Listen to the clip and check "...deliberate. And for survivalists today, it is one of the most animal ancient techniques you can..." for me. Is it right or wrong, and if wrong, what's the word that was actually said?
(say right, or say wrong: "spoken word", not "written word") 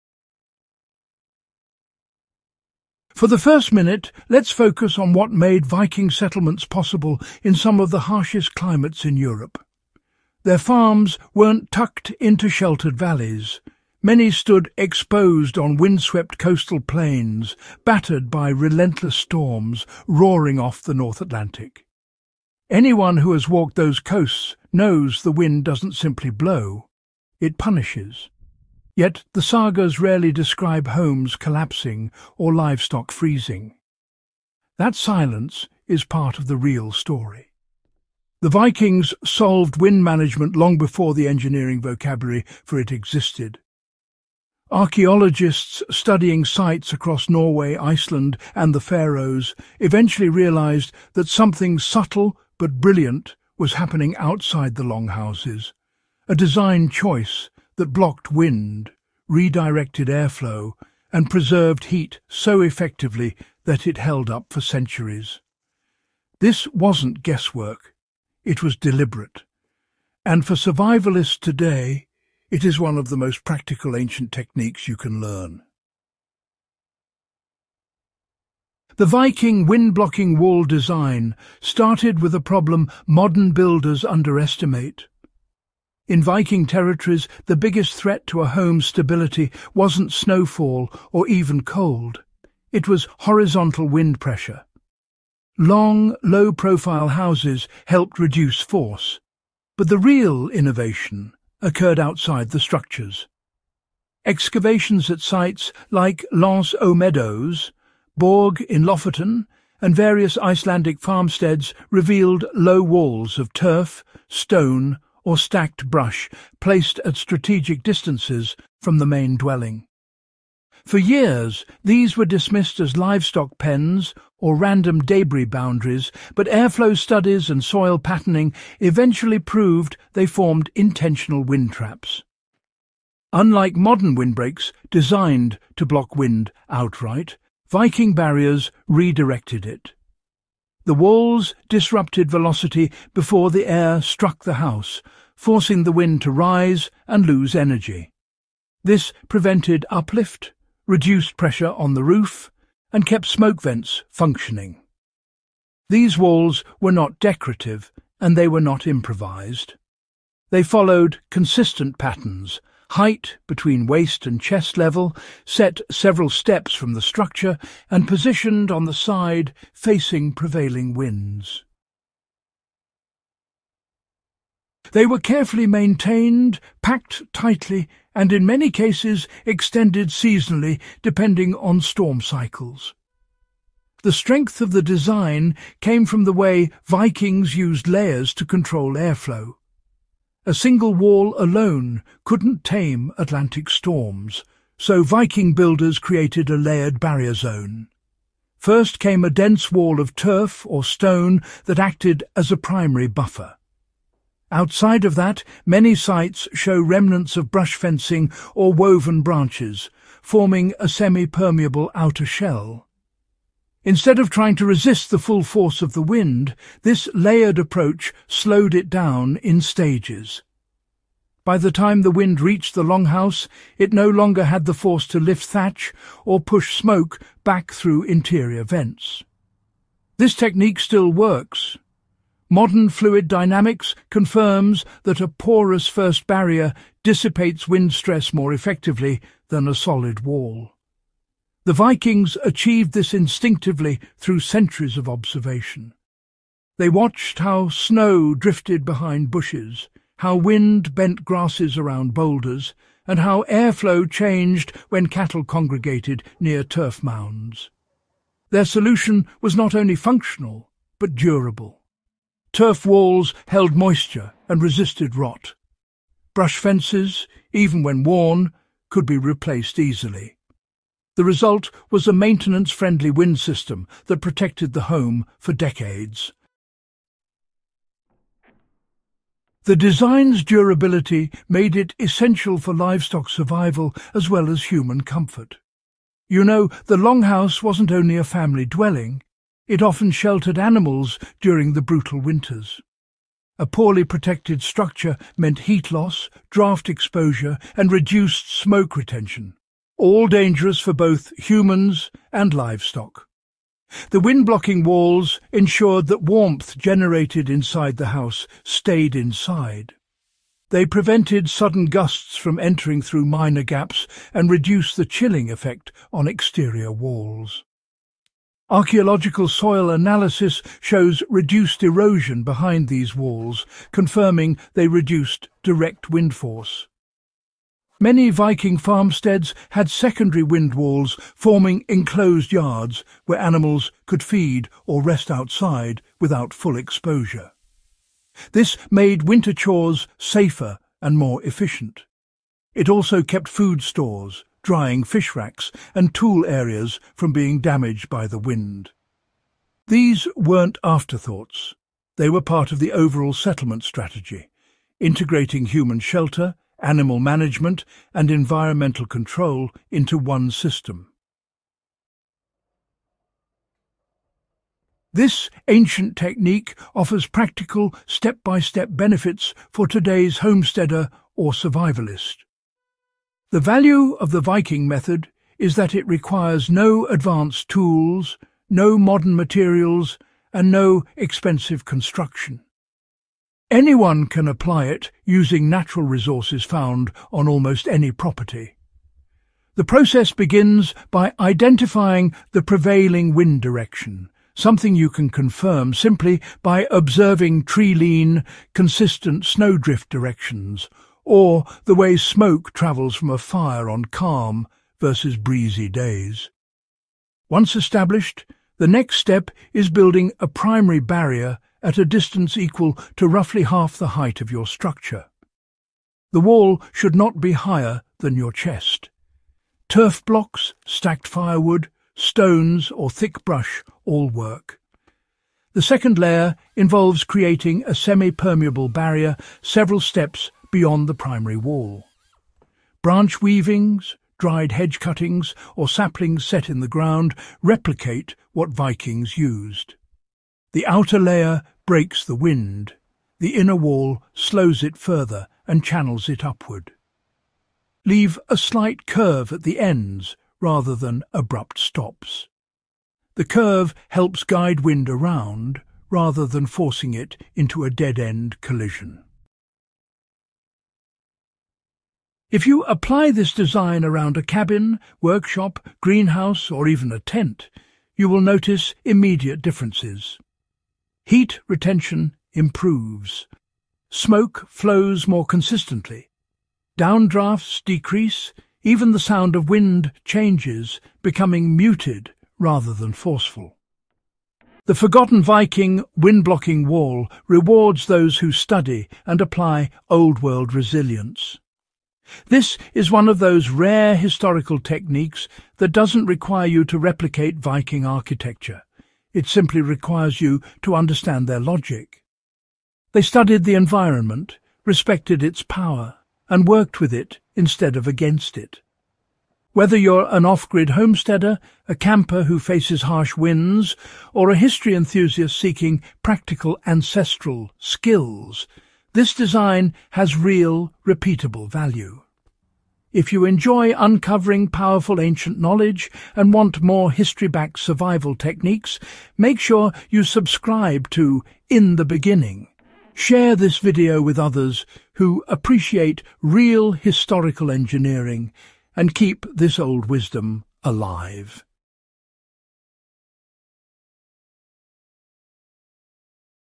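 wrong: "practical", not "animal".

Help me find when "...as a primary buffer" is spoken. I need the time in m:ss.
3:22.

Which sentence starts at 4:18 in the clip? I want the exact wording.
Their solution was not only functional, but durable.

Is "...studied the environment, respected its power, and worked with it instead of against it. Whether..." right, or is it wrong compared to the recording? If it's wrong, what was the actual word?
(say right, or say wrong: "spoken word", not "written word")
right.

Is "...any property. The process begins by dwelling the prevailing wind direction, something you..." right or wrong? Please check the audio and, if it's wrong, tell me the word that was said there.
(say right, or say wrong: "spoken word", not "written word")
wrong: "identifying", not "dwelling".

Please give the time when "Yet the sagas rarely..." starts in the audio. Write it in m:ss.
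0:28.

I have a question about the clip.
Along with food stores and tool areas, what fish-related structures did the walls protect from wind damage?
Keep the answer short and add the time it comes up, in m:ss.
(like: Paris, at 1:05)
Drying fish racks, at 5:44.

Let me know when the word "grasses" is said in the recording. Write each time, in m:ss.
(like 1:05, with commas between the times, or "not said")
4:11.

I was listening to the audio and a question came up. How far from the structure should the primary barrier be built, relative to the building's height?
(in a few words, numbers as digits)
Half the height.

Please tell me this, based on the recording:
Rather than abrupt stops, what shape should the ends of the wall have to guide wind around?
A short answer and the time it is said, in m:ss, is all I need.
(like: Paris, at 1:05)
A slight curve, at 7:28.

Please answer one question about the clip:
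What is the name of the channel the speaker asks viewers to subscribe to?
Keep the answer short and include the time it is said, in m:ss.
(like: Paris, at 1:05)
In the Beginning, at 8:51.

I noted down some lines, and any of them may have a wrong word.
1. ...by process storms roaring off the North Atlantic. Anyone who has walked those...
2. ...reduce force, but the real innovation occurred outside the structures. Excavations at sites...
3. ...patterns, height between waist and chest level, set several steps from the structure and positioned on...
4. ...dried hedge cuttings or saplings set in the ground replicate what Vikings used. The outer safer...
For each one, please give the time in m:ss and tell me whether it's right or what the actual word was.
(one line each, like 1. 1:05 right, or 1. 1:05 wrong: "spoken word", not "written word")
1. 0:18 wrong: "relentless", not "process"
2. 1:38 right
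3. 2:41 right
4. 7:14 wrong: "layer", not "safer".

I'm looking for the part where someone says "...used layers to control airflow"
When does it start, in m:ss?
3:07.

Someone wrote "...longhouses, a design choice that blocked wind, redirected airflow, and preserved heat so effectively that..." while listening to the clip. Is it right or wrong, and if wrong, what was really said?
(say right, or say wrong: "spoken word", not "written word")
right.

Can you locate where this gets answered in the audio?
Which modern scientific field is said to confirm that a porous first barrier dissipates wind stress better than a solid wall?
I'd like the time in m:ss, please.
3:52.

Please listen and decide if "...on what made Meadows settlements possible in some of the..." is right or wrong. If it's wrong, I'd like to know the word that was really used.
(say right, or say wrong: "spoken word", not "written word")
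wrong: "Viking", not "Meadows".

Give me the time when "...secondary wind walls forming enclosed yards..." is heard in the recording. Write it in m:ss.
5:29.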